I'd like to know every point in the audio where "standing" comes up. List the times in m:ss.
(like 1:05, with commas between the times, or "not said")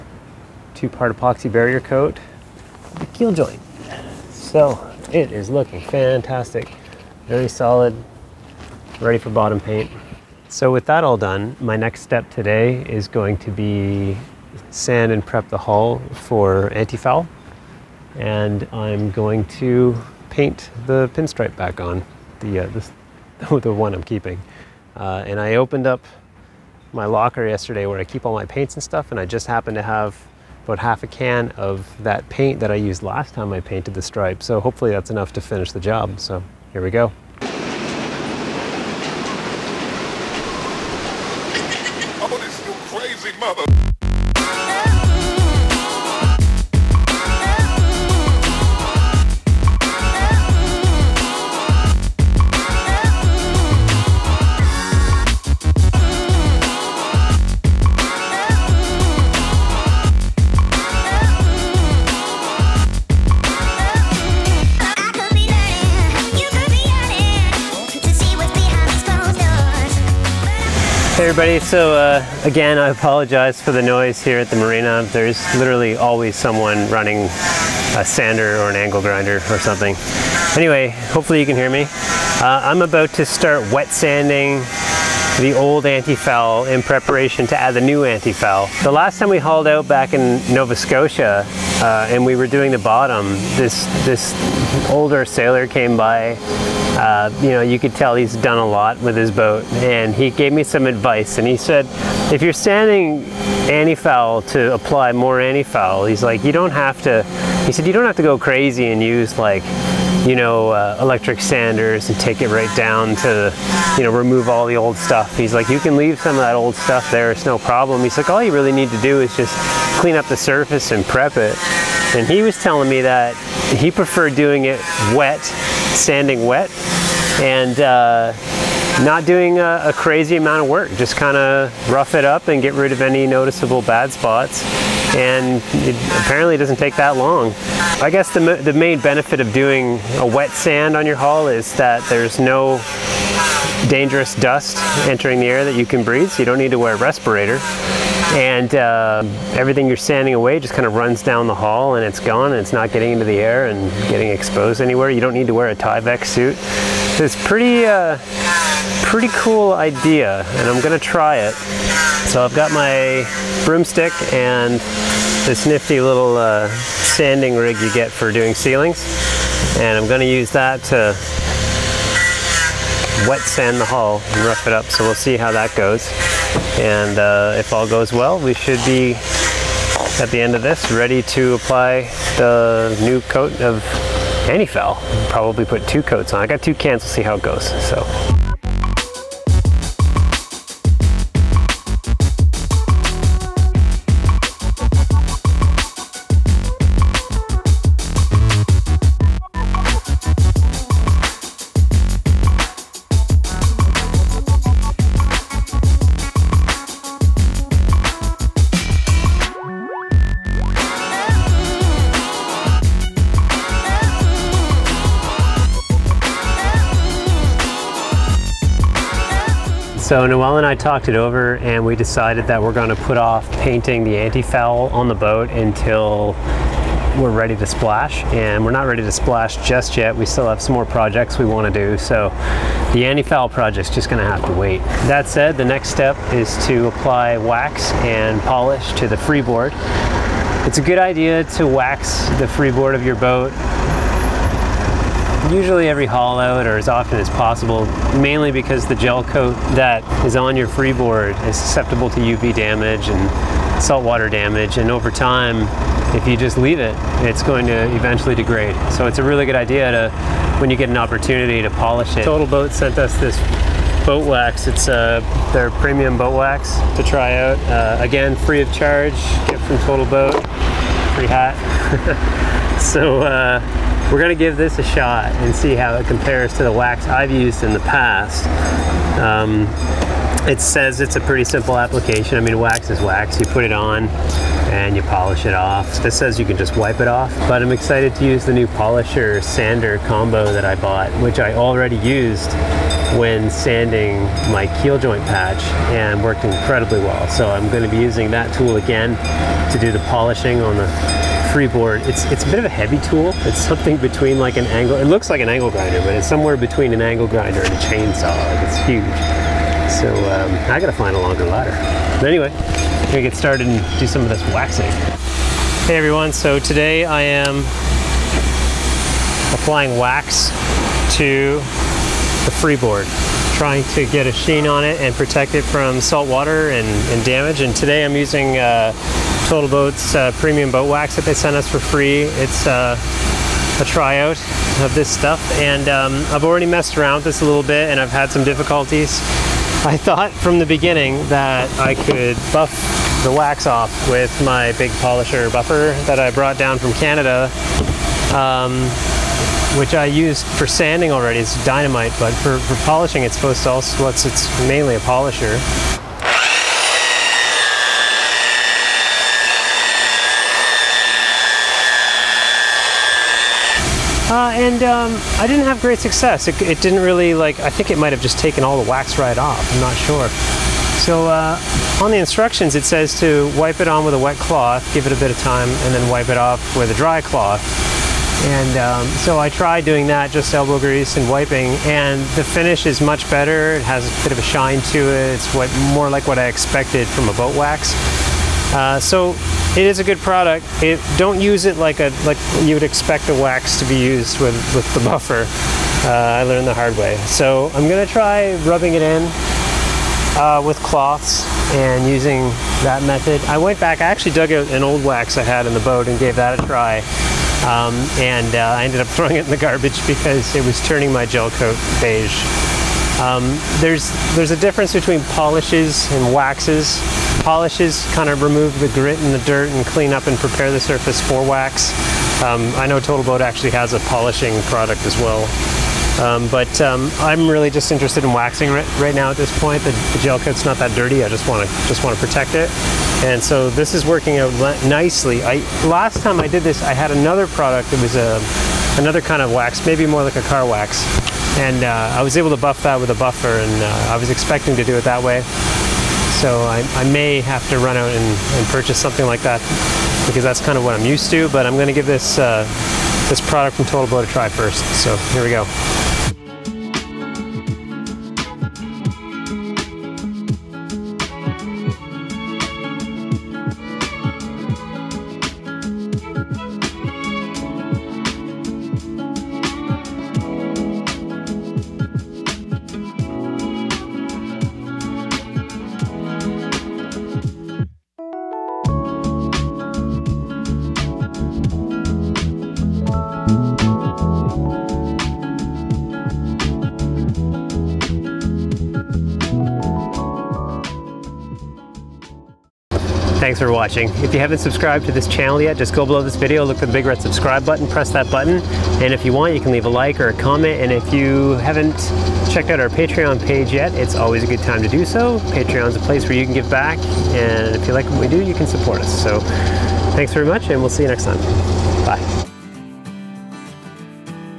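1:42.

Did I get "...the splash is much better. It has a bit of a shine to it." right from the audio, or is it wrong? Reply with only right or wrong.
wrong.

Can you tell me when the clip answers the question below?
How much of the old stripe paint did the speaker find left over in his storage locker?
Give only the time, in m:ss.
0:30.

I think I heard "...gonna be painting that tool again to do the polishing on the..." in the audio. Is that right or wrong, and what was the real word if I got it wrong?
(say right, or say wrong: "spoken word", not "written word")
wrong: "using", not "painting".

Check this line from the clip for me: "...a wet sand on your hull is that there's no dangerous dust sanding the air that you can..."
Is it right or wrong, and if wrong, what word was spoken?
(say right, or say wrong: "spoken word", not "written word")
wrong: "entering", not "sanding".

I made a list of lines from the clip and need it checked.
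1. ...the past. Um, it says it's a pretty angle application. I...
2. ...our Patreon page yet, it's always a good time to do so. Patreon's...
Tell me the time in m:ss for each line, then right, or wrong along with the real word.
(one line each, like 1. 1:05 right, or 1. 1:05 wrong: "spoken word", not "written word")
1. 4:37 wrong: "simple", not "angle"
2. 8:22 right.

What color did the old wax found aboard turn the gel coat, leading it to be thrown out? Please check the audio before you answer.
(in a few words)
beige.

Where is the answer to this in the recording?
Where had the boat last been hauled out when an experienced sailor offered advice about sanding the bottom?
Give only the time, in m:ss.
1:30.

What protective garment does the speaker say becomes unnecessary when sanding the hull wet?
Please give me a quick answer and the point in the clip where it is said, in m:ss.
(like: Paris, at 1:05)
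Tyvek suit, at 2:35.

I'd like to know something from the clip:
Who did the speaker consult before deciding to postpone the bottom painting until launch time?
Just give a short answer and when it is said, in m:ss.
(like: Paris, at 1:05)
Nawal, at 3:40.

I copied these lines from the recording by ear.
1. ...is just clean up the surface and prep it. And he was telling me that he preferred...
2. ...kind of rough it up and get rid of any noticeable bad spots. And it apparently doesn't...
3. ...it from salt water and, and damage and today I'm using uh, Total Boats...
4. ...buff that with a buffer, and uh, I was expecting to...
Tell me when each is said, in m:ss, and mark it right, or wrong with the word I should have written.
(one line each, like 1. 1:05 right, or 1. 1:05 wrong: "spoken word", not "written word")
1. 1:59 right
2. 2:11 right
3. 5:25 right
4. 7:22 right.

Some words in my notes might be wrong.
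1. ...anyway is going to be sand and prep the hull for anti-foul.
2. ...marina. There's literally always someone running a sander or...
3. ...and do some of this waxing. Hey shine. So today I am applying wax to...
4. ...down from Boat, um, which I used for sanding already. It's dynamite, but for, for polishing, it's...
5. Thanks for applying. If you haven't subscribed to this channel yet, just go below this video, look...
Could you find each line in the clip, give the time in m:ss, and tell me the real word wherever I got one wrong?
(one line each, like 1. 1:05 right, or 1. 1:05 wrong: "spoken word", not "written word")
1. 0:12 wrong: "today", not "anyway"
2. 1:14 right
3. 5:13 wrong: "everyone", not "shine"
4. 5:46 wrong: "Canada", not "Boat"
5. 8:13 wrong: "watching", not "applying".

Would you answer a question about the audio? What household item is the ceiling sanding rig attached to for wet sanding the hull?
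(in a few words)
broomstick.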